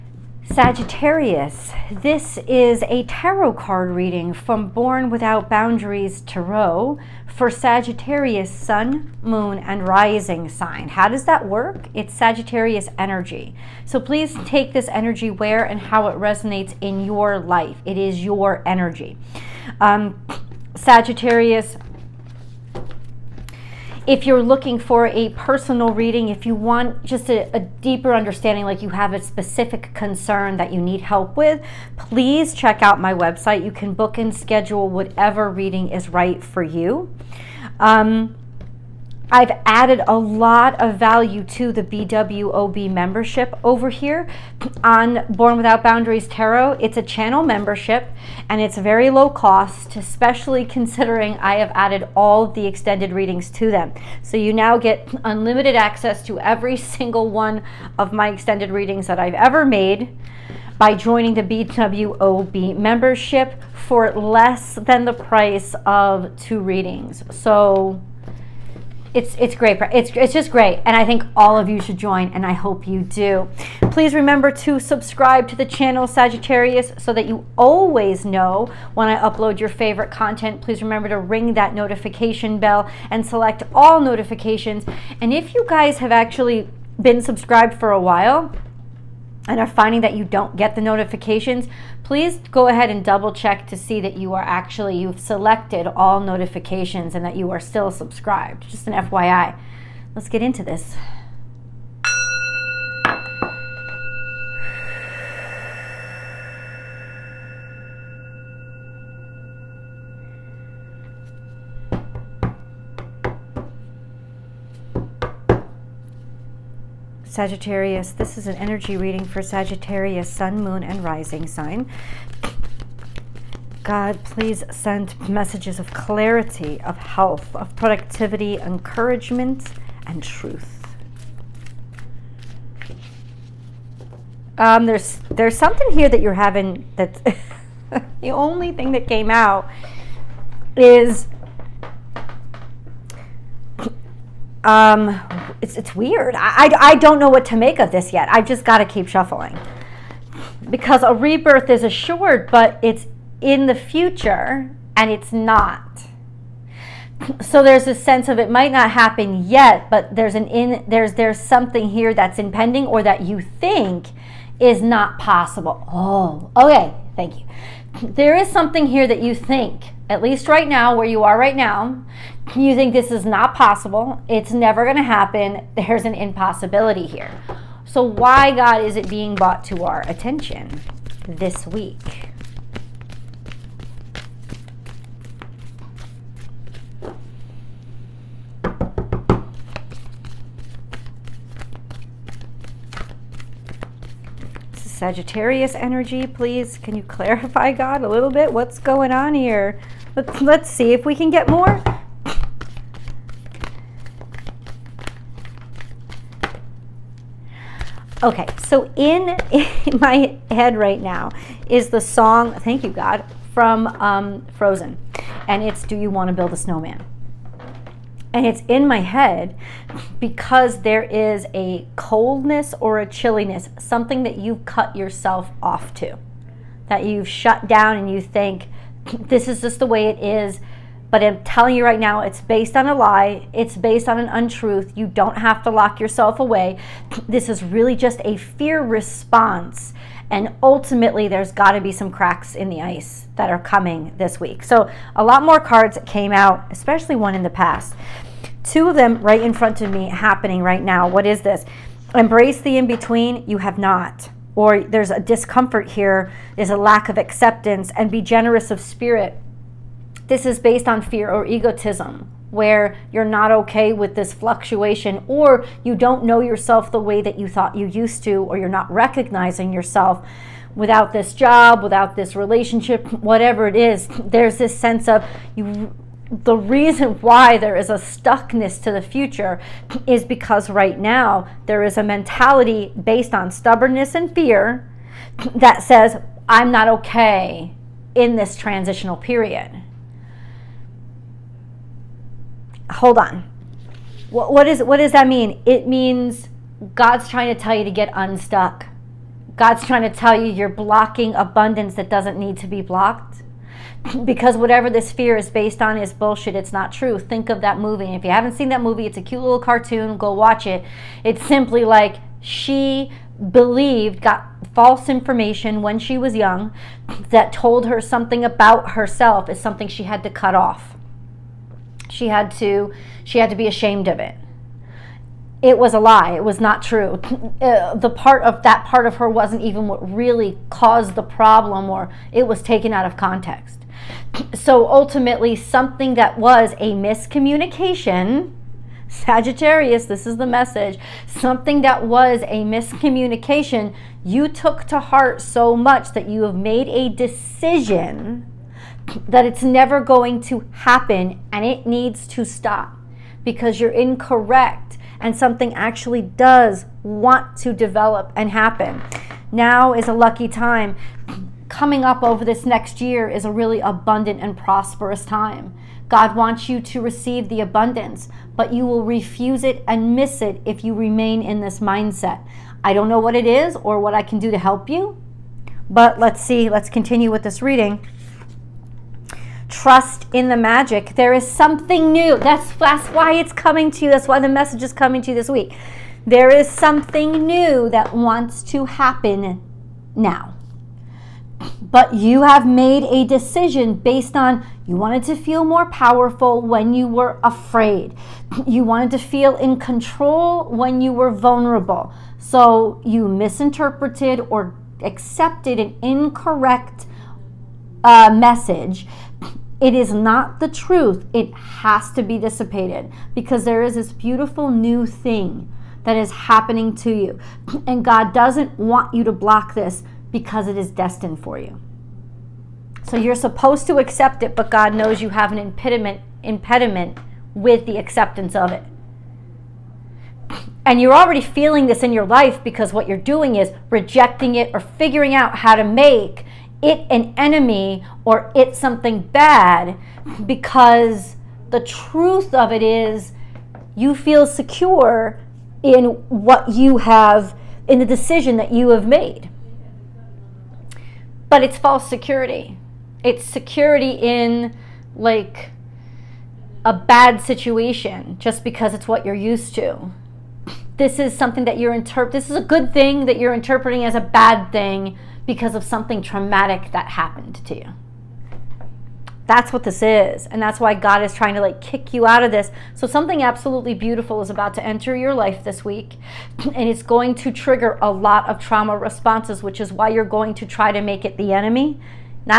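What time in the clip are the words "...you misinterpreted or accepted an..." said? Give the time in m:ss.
6:43.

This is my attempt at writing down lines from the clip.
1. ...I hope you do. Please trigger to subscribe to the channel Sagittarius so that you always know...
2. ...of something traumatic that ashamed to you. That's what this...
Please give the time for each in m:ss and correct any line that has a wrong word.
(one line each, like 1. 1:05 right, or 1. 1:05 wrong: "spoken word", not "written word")
1. 1:12 wrong: "remember", not "trigger"
2. 7:45 wrong: "happened", not "ashamed".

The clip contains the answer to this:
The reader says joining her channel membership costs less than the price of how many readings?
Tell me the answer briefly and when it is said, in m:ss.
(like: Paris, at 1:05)
2, at 1:06.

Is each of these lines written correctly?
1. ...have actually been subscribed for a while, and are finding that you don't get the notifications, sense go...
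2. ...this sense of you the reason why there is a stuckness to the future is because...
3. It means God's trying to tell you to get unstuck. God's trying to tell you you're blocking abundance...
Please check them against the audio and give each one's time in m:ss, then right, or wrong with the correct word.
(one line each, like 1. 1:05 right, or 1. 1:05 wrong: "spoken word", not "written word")
1. 1:25 wrong: "please", not "sense"
2. 4:34 right
3. 4:55 right.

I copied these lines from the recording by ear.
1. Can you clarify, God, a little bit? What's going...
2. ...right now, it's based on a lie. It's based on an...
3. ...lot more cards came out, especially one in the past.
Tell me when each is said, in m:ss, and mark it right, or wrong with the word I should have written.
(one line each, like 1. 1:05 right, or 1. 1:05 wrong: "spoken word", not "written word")
1. 3:16 right
2. 3:51 right
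3. 4:05 right.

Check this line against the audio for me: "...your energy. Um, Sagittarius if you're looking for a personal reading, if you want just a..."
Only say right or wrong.
right.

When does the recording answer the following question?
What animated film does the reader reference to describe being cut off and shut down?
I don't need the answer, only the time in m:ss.
3:34.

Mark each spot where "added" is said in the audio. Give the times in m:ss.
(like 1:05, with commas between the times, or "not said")
0:39, 0:51.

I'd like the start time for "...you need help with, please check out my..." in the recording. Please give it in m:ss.
0:30.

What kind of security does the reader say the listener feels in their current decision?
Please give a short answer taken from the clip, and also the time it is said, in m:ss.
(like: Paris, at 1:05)
False security, at 7:31.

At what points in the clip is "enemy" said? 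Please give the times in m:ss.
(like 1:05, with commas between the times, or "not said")
7:17, 8:01.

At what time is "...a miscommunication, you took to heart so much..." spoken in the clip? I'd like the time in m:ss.
5:42.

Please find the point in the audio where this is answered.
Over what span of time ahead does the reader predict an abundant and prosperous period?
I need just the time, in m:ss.
6:02.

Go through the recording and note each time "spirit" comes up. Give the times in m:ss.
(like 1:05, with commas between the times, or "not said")
4:18.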